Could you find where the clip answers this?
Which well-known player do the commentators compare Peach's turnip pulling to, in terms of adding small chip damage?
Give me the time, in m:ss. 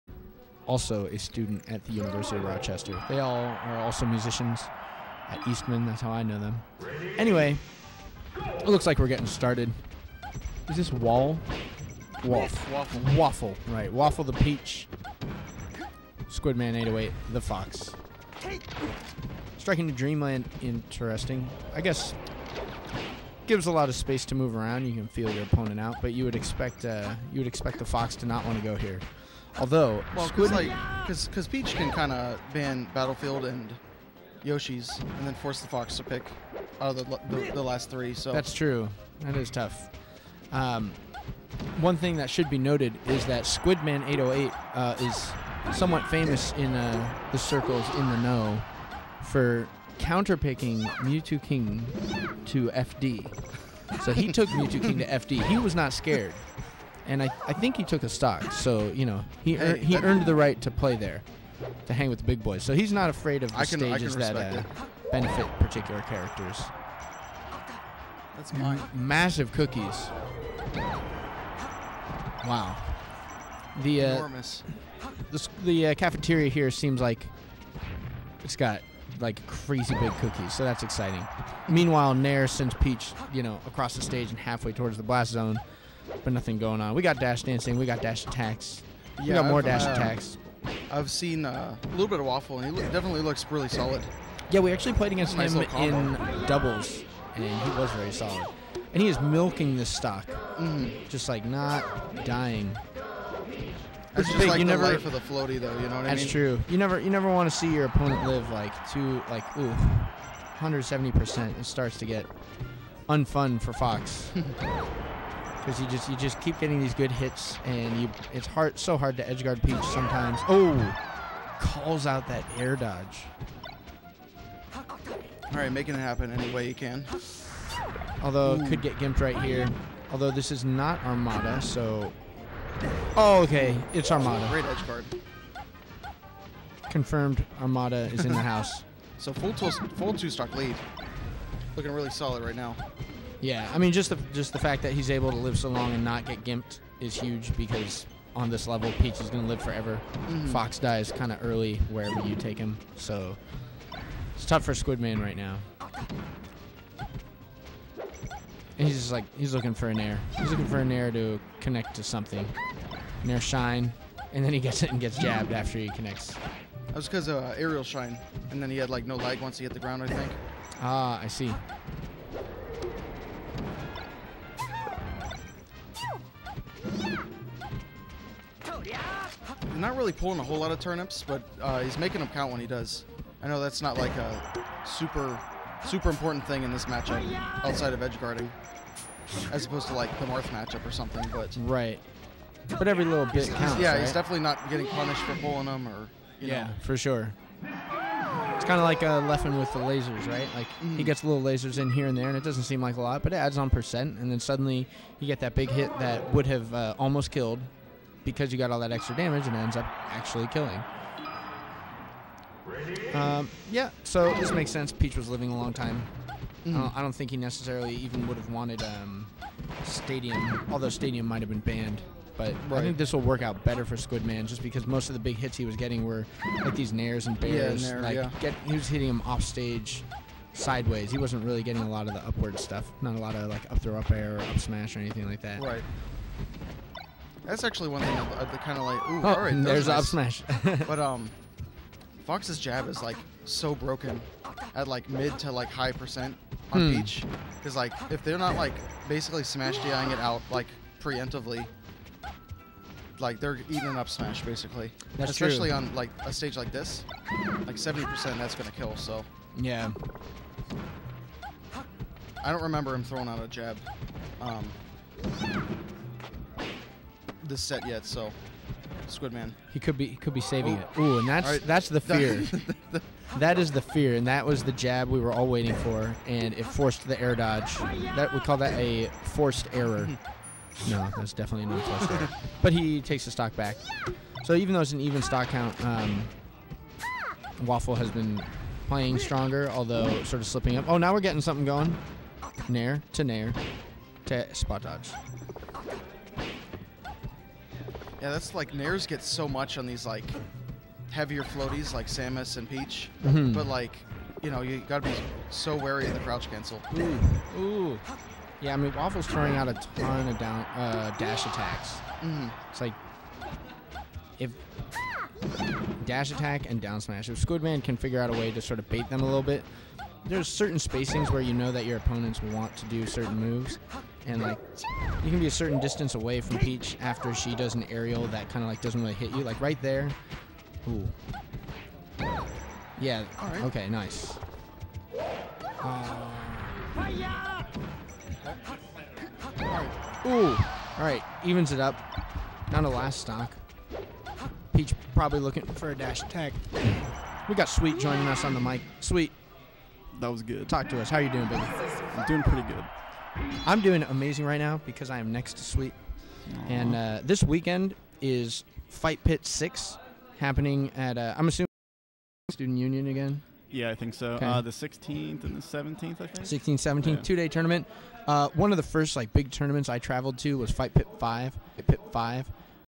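3:19.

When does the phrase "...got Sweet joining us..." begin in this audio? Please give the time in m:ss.
5:47.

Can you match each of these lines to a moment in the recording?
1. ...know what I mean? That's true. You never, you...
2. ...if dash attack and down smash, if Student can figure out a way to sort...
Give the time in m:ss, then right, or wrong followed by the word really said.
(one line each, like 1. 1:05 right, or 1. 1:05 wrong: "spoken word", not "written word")
1. 1:45 right
2. 5:14 wrong: "Squidman", not "Student".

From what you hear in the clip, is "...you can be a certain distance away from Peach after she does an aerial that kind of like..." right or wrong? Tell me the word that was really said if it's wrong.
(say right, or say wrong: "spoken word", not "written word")
right.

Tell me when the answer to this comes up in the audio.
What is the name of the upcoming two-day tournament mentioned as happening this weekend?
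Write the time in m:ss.
5:58.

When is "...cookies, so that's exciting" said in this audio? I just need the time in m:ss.
1:20.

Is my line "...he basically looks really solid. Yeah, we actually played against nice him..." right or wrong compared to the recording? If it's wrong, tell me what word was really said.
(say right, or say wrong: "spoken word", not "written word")
wrong: "definitely", not "basically".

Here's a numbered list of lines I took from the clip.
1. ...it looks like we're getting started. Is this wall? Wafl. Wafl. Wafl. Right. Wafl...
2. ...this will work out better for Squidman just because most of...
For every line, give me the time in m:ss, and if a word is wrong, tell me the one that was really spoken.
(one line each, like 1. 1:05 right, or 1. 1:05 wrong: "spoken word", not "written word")
1. 0:08 right
2. 3:42 right.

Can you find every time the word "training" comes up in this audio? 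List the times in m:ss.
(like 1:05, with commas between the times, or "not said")
not said.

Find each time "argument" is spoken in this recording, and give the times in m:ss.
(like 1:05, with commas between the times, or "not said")
not said.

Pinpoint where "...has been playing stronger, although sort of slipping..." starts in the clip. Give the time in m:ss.
4:47.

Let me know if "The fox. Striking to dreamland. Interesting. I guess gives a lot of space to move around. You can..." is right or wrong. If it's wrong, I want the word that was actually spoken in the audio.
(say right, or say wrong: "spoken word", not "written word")
right.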